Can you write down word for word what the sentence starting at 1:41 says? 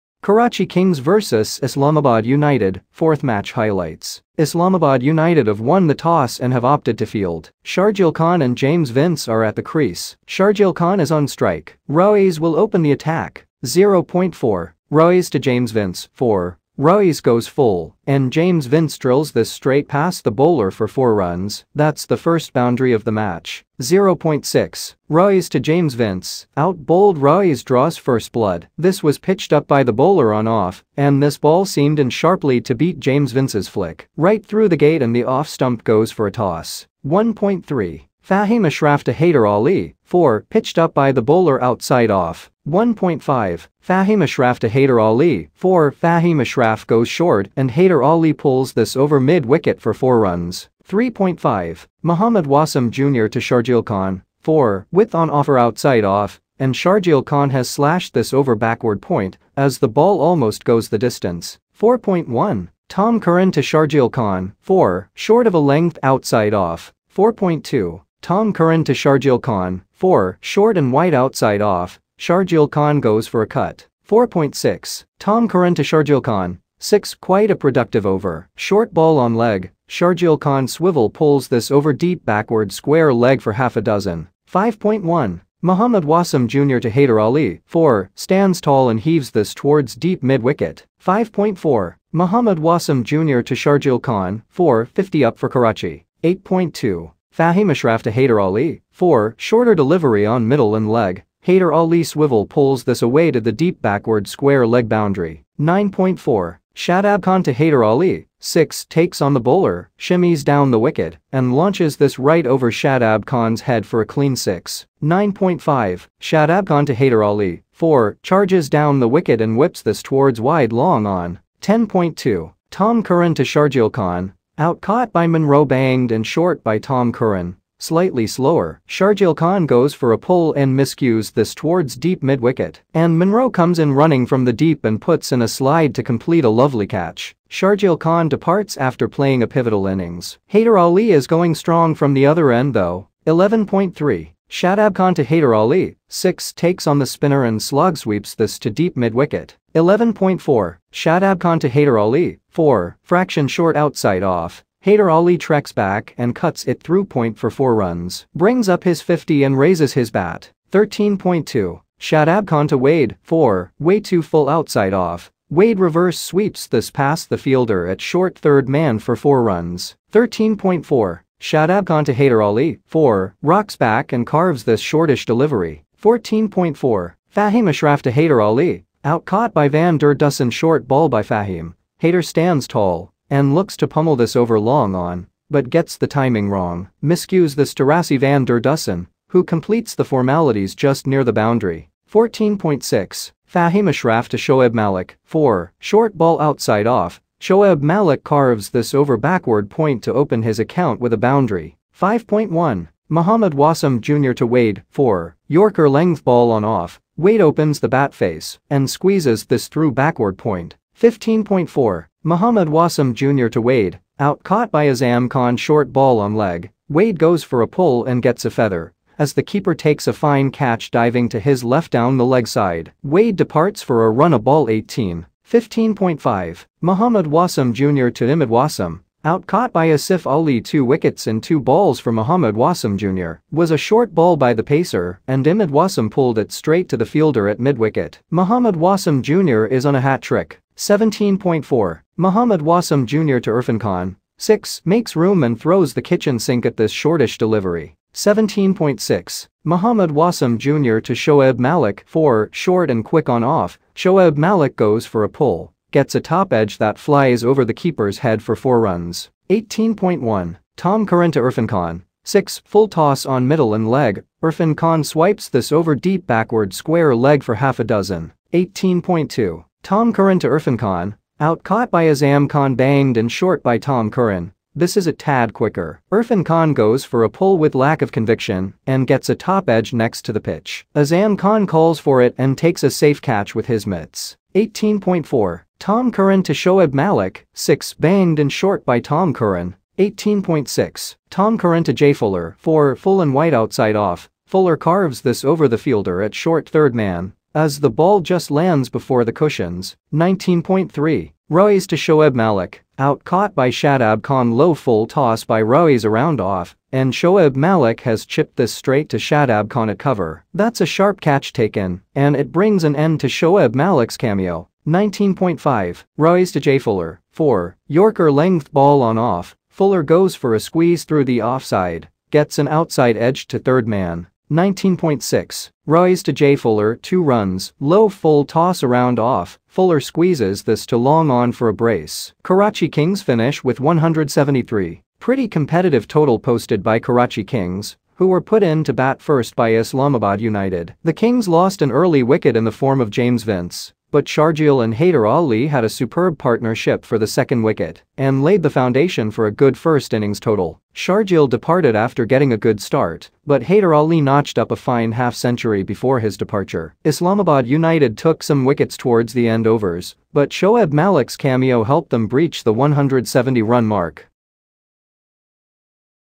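Haider Ali swivel pulls this away to the deep backward square leg boundary.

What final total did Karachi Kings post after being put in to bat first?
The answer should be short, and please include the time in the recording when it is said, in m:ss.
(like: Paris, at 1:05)
173, at 5:33.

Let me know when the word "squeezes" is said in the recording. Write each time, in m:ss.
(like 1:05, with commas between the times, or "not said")
3:28, 5:20, 5:30.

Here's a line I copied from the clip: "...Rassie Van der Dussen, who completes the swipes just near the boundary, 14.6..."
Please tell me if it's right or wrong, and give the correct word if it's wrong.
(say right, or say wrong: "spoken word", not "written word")
wrong: "formalities", not "swipes".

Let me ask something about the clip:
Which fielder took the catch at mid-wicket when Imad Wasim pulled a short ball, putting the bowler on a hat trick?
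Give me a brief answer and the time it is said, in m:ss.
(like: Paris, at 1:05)
Asif Ali, at 3:49.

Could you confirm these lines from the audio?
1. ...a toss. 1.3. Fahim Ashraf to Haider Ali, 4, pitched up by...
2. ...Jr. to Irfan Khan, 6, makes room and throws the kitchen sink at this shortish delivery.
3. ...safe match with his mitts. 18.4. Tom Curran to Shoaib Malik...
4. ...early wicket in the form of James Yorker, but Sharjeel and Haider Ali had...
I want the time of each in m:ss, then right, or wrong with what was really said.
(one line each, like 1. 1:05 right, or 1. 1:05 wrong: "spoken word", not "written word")
1. 0:36 right
2. 4:03 right
3. 4:42 wrong: "catch", not "match"
4. 5:41 wrong: "Vince", not "Yorker".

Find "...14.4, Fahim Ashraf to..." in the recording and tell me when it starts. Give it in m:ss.
2:55.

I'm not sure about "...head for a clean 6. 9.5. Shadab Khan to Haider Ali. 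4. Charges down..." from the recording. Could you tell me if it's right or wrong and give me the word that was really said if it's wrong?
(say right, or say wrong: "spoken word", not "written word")
right.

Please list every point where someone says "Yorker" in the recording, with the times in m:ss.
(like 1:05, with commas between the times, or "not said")
3:25, 5:17.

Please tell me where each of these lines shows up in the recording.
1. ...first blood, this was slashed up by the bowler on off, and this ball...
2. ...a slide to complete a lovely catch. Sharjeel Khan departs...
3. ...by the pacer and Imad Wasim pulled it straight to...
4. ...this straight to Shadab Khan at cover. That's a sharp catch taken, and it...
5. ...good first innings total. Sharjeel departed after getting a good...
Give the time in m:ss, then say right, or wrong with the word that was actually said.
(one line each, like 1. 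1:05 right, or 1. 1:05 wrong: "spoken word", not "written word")
1. 0:27 wrong: "pitched", not "slashed"
2. 2:15 right
3. 3:54 right
4. 5:08 right
5. 5:49 right.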